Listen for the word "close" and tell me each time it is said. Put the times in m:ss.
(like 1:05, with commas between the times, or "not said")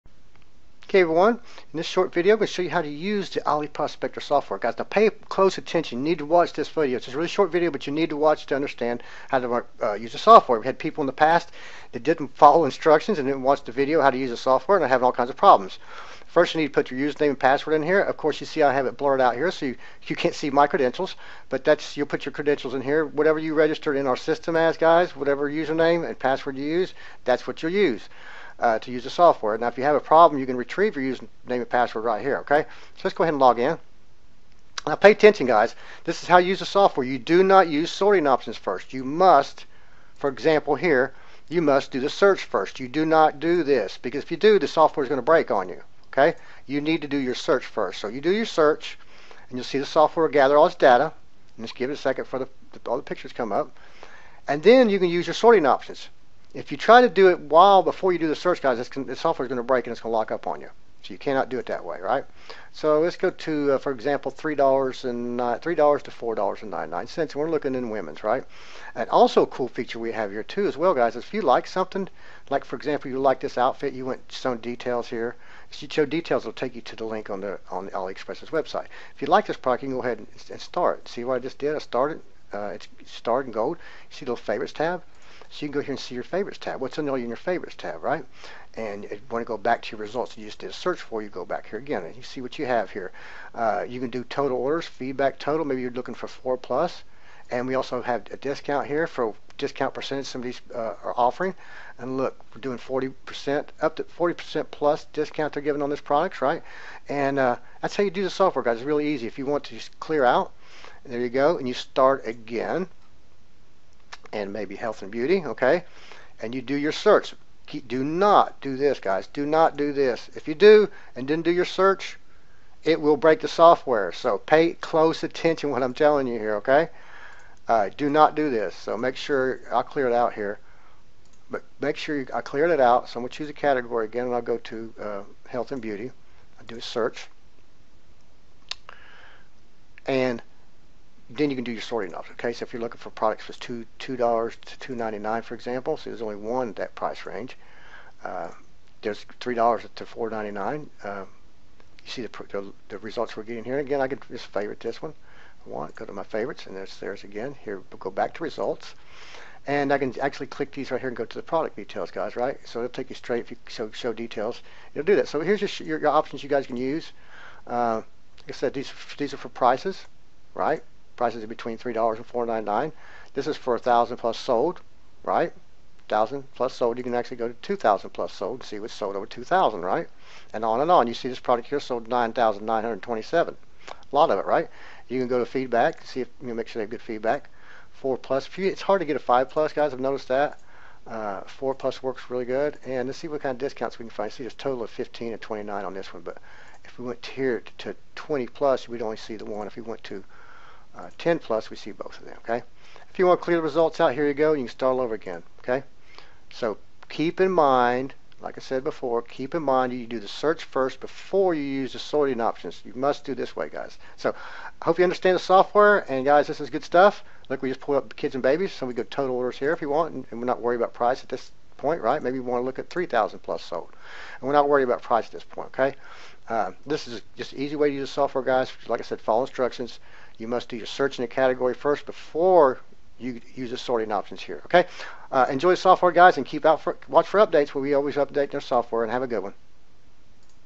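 0:05, 2:04.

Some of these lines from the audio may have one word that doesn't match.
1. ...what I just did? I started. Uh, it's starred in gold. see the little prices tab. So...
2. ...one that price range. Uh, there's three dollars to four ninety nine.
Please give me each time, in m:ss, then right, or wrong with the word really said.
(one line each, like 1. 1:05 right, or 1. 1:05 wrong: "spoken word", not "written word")
1. 1:21 wrong: "favorites", not "prices"
2. 2:26 right.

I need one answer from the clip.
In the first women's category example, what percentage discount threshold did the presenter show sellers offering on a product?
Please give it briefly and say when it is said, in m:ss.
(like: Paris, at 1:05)
40%, at 1:43.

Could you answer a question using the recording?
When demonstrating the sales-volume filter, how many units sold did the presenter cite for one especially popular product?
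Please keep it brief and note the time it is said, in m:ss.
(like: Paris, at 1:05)
9,927, at 3:02.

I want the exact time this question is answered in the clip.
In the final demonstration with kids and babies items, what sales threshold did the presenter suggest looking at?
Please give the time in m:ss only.
3:42.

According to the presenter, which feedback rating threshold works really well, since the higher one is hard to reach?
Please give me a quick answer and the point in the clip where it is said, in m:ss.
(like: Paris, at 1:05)
4 plus, at 3:11.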